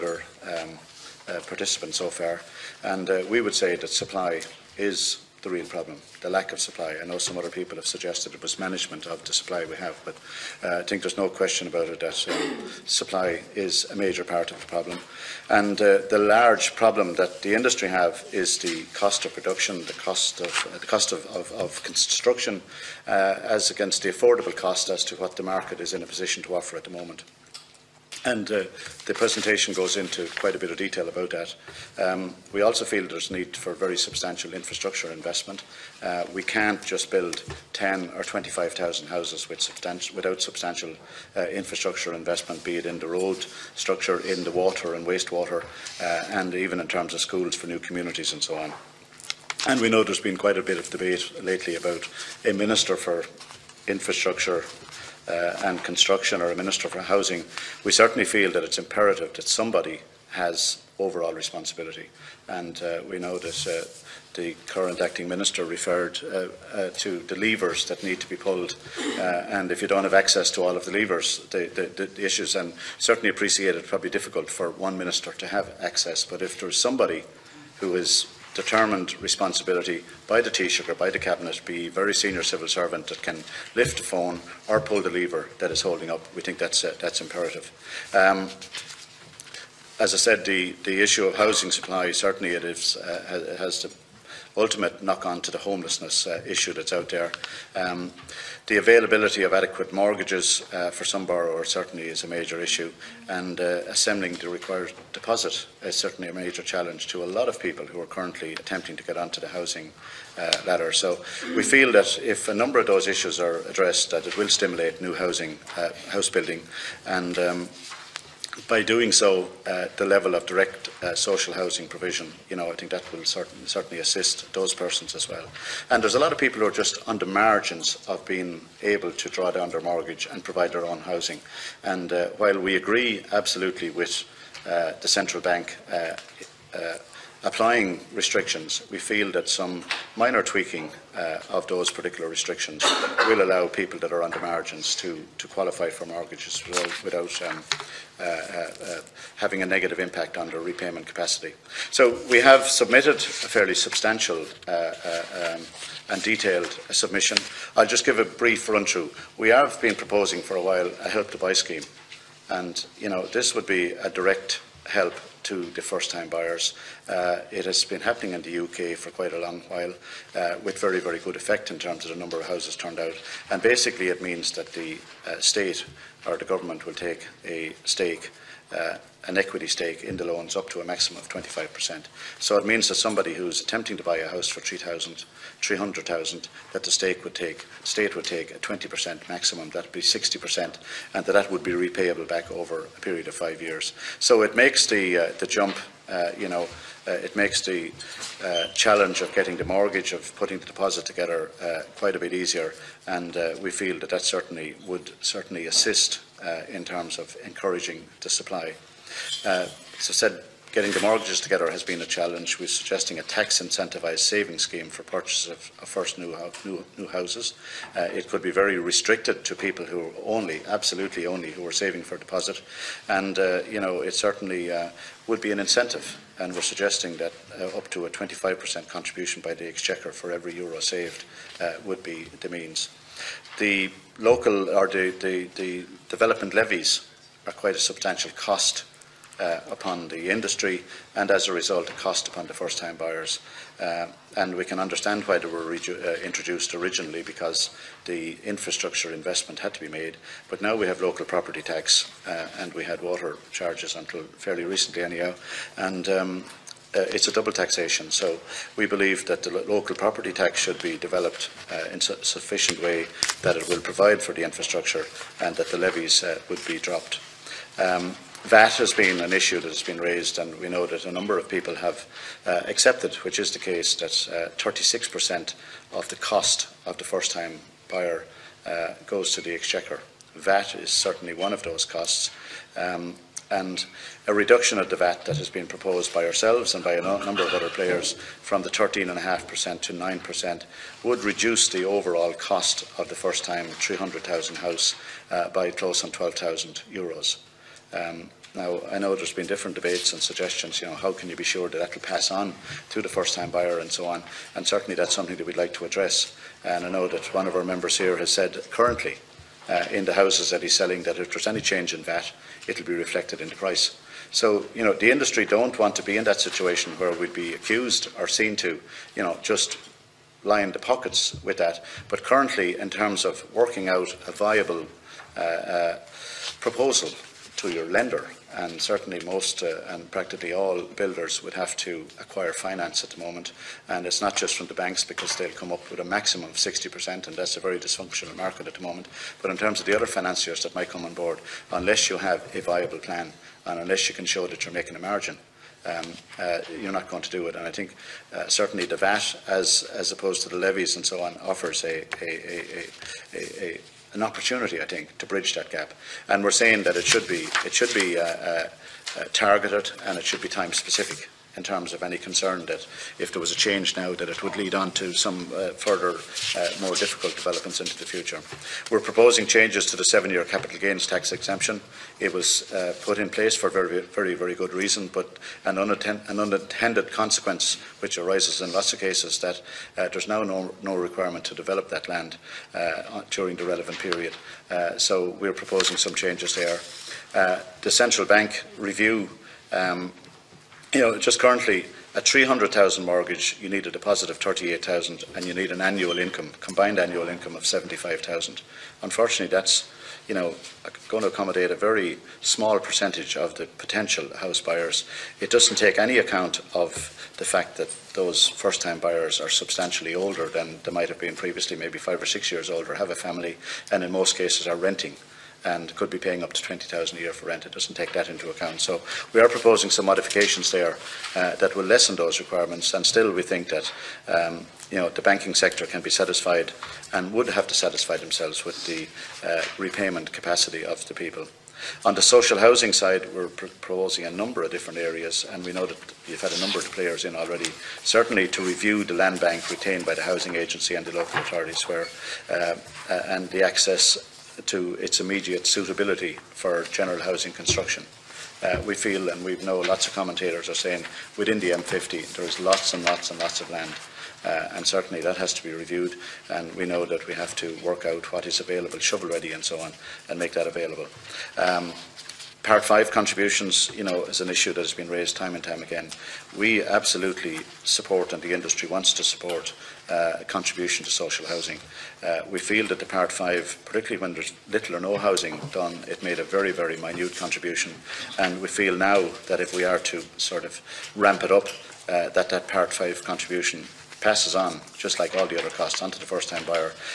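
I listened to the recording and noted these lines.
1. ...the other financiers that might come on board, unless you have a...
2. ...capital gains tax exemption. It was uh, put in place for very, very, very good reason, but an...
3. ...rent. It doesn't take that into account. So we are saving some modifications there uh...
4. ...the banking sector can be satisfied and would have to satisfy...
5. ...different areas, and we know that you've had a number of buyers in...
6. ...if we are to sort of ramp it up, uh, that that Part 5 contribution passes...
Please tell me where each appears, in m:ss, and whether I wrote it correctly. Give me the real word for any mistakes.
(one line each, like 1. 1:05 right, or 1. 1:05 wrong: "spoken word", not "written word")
1. 5:39 right
2. 6:10 right
3. 6:57 wrong: "proposing", not "saving"
4. 7:05 right
5. 7:14 wrong: "players", not "buyers"
6. 7:59 right.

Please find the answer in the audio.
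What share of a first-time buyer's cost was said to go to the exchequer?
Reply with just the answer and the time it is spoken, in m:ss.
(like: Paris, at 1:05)
36%, at 4:34.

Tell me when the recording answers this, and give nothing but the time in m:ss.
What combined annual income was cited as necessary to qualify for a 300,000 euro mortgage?
6:37.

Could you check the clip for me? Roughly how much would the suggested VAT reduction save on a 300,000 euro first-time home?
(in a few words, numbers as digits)
12,000 euros.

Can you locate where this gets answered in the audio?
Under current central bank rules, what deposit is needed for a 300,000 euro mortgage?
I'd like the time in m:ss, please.
6:34.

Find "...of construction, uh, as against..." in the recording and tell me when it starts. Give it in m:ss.
0:21.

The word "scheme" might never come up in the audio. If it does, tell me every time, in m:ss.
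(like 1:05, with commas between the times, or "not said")
2:41, 3:34.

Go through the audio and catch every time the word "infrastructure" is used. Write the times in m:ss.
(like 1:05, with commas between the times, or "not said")
0:34, 0:41, 0:53, 4:08, 4:24.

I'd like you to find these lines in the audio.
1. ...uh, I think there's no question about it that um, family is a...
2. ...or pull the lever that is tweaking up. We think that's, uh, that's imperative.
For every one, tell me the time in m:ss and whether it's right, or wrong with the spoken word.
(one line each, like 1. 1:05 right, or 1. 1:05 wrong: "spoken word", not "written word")
1. 0:10 wrong: "supply", not "family"
2. 1:24 wrong: "holding", not "tweaking".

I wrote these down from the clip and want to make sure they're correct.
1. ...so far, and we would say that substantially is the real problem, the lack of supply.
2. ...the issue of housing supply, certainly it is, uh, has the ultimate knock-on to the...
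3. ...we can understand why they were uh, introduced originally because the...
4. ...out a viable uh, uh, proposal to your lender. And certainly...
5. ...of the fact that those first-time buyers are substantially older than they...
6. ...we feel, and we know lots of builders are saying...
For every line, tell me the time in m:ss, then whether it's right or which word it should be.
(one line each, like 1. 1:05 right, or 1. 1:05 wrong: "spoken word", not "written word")
1. 0:01 wrong: "supply", not "substantially"
2. 1:30 right
3. 4:04 right
4. 5:23 right
5. 6:46 right
6. 7:28 wrong: "commentators", not "builders".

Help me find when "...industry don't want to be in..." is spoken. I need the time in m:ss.
5:15.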